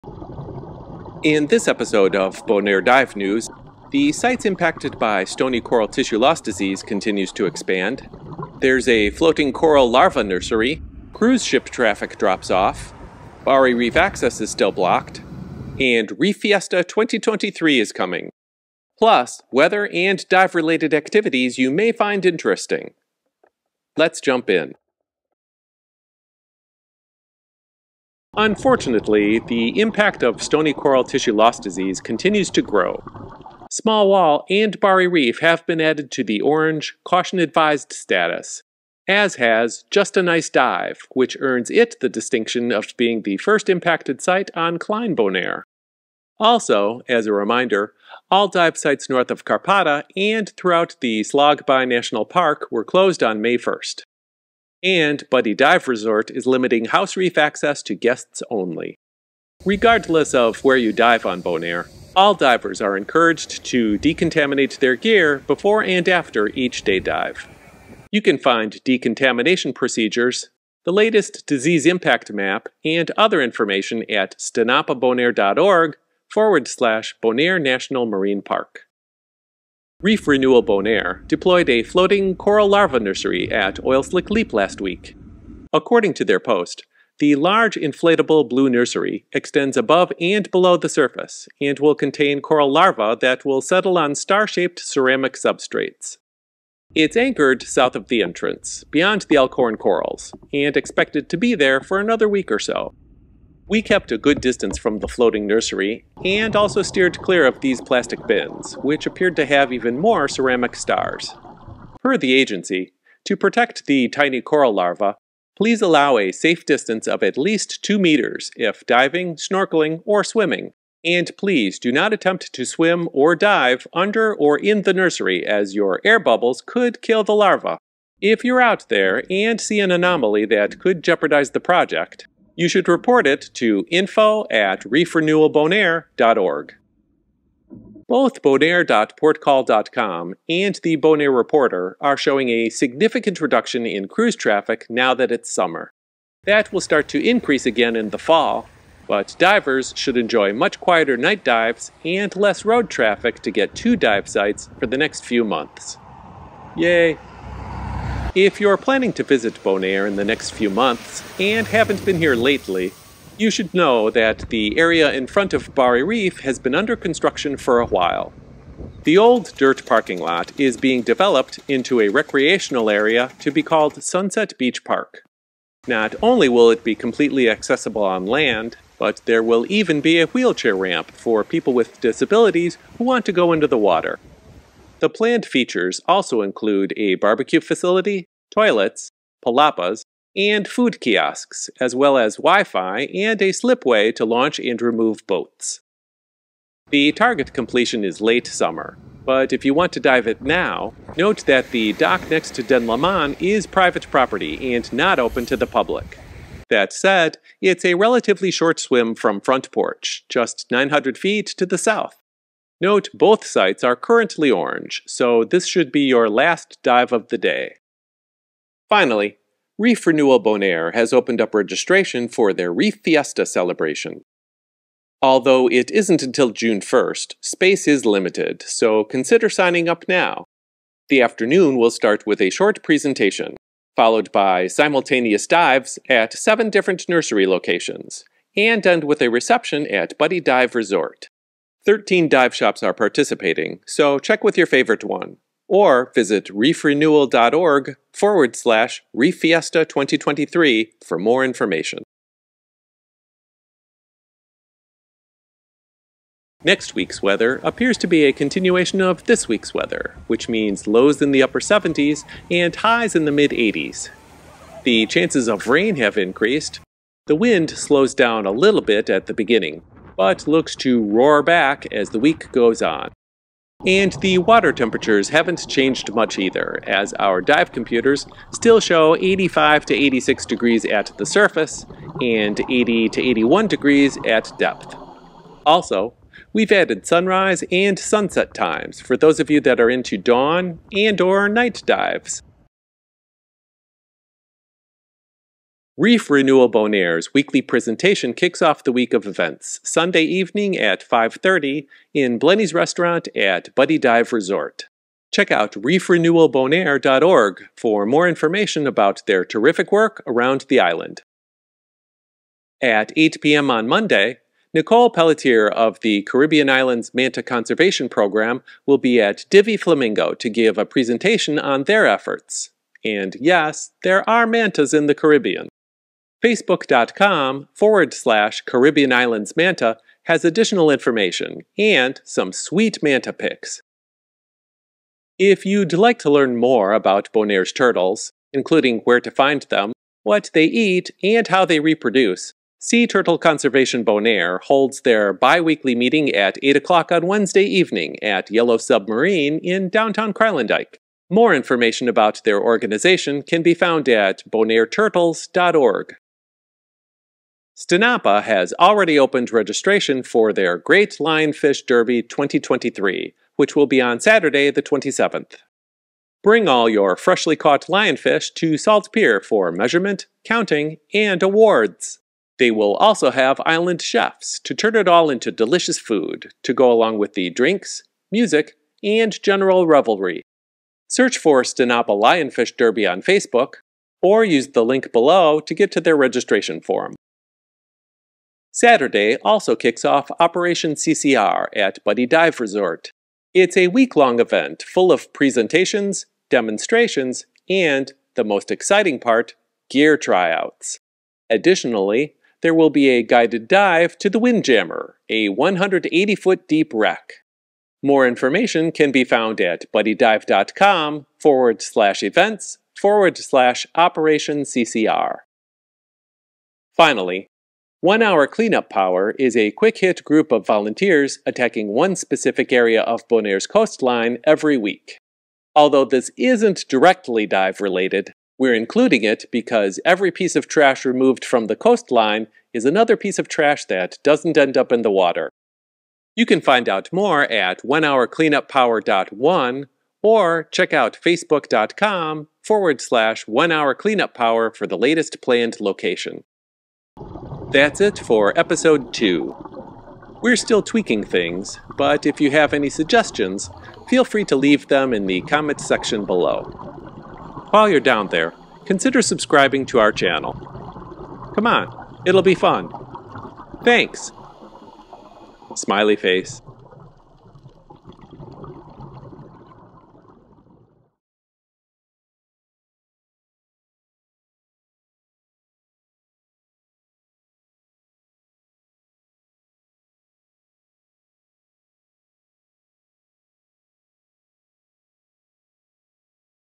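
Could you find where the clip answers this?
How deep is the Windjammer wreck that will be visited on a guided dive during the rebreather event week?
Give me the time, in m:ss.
6:45.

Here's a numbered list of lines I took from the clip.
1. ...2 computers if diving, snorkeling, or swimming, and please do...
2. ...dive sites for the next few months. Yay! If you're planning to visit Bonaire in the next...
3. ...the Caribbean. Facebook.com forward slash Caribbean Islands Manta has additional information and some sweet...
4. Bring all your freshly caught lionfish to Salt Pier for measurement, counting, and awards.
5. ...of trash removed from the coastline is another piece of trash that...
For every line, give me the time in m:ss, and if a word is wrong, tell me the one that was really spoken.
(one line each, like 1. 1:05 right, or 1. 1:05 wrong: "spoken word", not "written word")
1. 1:57 wrong: "meters", not "computers"
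2. 2:33 right
3. 5:25 right
4. 6:06 right
5. 7:10 right.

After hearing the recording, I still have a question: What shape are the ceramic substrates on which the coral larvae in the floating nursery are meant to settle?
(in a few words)
Star-shaped.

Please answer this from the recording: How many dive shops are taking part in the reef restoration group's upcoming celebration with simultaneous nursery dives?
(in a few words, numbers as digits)
13.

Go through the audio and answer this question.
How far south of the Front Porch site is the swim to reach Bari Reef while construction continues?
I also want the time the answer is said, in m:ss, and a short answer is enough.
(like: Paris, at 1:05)
900 feet, at 3:30.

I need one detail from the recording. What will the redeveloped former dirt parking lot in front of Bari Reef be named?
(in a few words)
Sunset Beach Park.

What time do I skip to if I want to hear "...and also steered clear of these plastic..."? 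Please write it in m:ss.
1:46.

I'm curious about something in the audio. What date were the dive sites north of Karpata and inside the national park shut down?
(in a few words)
May 1st.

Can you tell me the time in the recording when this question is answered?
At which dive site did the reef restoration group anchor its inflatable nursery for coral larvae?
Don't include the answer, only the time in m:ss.
1:23.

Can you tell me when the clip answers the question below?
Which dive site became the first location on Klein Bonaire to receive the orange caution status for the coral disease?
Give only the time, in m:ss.
0:39.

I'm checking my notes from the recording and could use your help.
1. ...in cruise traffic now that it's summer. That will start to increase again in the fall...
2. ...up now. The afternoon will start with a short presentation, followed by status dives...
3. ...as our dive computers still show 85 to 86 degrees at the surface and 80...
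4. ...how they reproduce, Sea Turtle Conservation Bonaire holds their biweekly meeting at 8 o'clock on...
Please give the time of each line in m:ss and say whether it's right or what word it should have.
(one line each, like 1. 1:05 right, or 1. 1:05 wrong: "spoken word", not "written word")
1. 2:23 right
2. 3:49 wrong: "simultaneous", not "status"
3. 4:36 right
4. 5:41 right.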